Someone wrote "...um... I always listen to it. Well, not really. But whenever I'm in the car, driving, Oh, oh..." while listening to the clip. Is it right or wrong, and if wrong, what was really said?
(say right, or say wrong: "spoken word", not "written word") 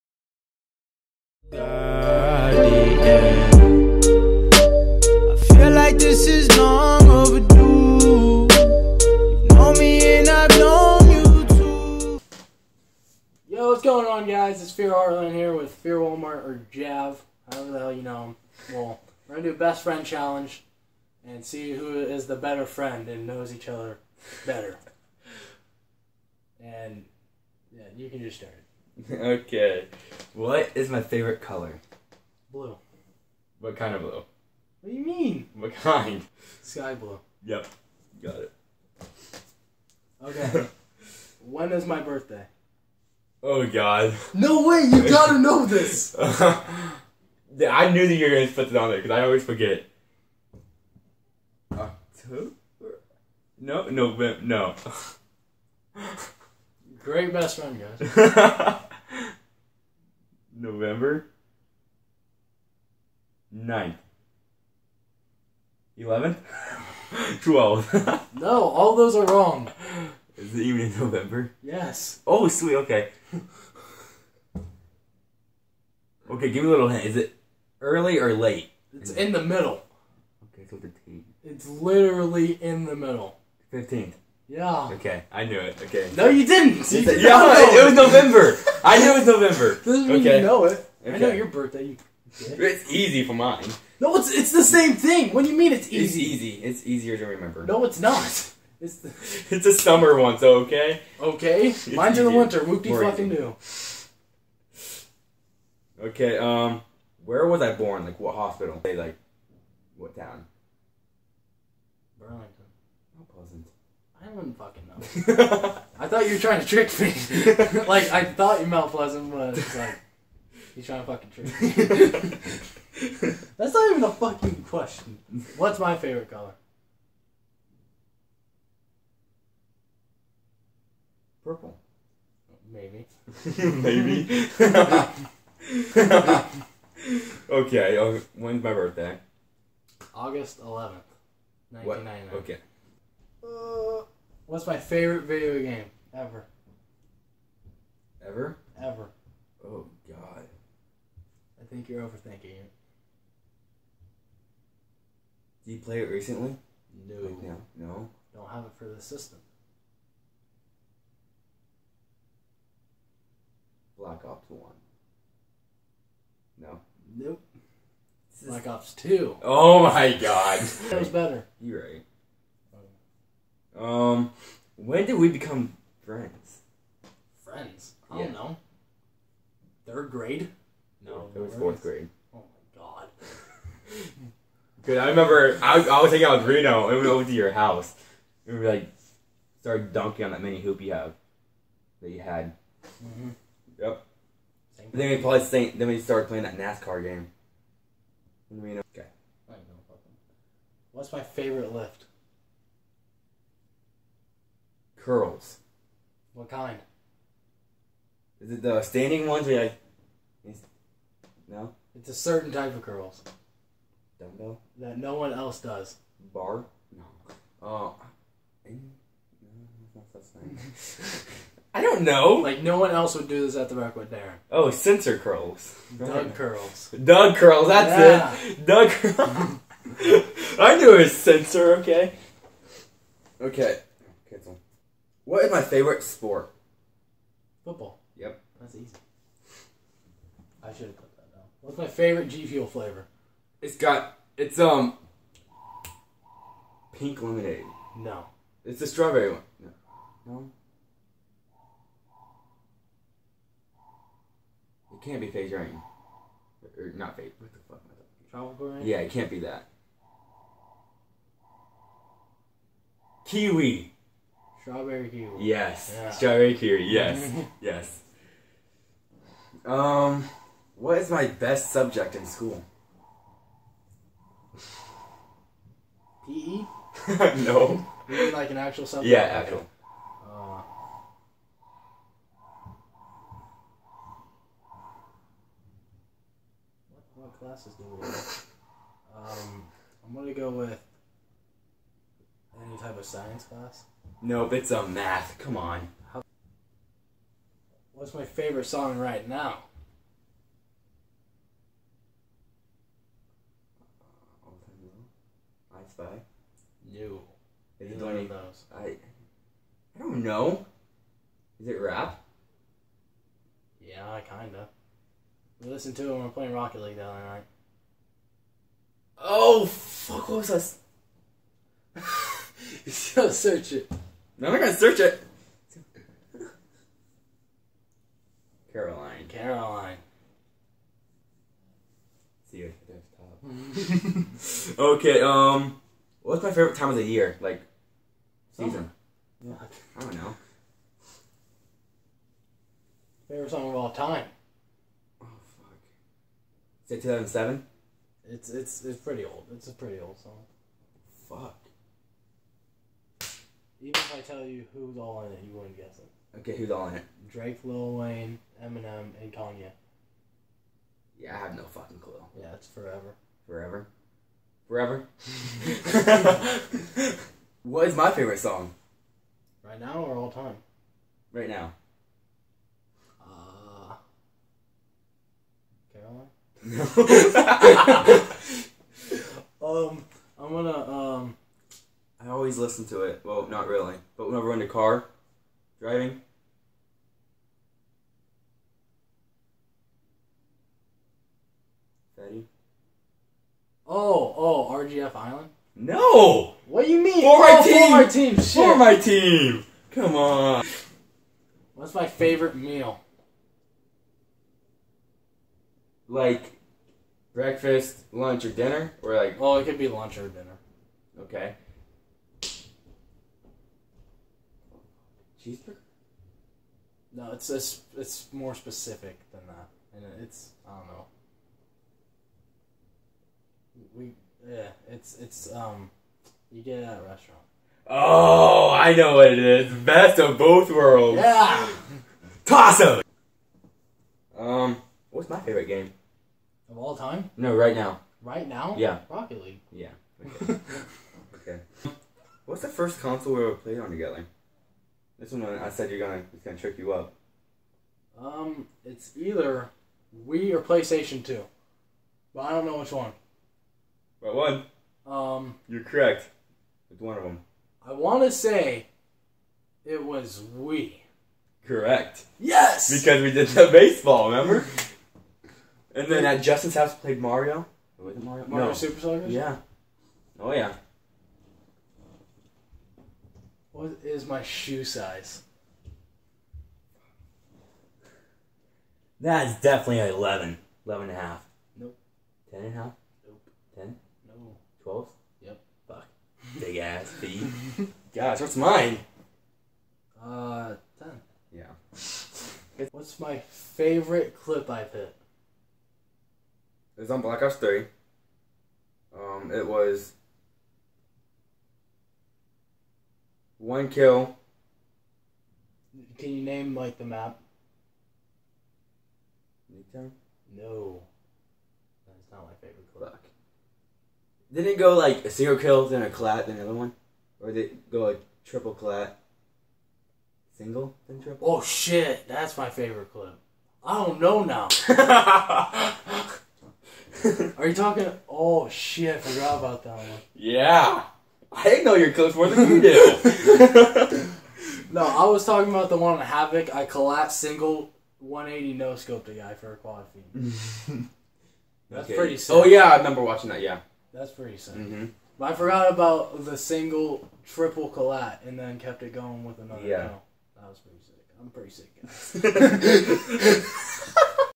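right.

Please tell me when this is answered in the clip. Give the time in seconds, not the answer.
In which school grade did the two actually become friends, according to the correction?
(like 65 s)
181 s.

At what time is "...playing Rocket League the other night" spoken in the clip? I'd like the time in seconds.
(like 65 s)
316 s.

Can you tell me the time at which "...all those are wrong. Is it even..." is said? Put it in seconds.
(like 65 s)
68 s.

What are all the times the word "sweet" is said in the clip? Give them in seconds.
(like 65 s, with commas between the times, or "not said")
72 s.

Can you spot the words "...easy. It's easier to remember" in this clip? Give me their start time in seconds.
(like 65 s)
96 s.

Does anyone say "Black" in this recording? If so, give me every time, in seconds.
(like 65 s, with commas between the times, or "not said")
163 s, 168 s, 497 s.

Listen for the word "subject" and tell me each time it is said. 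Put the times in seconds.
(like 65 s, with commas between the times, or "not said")
271 s, 278 s.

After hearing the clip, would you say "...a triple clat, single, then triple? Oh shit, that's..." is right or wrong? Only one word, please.
right.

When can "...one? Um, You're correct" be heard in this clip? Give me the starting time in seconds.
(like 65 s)
454 s.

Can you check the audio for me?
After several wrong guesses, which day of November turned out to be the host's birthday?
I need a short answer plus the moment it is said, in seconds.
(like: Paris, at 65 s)
15th, at 83 s.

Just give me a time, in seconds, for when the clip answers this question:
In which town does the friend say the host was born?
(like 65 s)
112 s.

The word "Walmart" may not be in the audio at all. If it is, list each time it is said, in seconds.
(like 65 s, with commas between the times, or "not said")
15 s.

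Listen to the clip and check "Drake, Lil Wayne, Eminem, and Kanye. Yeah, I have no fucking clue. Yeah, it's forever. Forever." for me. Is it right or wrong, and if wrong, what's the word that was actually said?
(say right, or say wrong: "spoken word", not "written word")
right.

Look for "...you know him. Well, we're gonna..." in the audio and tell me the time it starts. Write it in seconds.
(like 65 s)
17 s.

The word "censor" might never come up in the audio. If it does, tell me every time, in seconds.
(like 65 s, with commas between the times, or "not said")
224 s, 231 s.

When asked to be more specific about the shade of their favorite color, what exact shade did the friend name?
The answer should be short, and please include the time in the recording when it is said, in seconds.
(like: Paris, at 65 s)
Sky blue, at 36 s.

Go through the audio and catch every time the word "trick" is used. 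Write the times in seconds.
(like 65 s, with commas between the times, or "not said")
116 s, 121 s, 446 s.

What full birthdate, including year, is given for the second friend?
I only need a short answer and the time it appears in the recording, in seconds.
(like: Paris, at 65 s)
August 11th, 1999, at 140 s.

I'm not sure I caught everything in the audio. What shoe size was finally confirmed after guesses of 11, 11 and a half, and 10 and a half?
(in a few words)
12.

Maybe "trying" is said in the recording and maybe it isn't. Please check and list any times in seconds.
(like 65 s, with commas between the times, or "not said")
116 s, 120 s.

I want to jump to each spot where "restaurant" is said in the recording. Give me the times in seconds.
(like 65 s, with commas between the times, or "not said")
427 s.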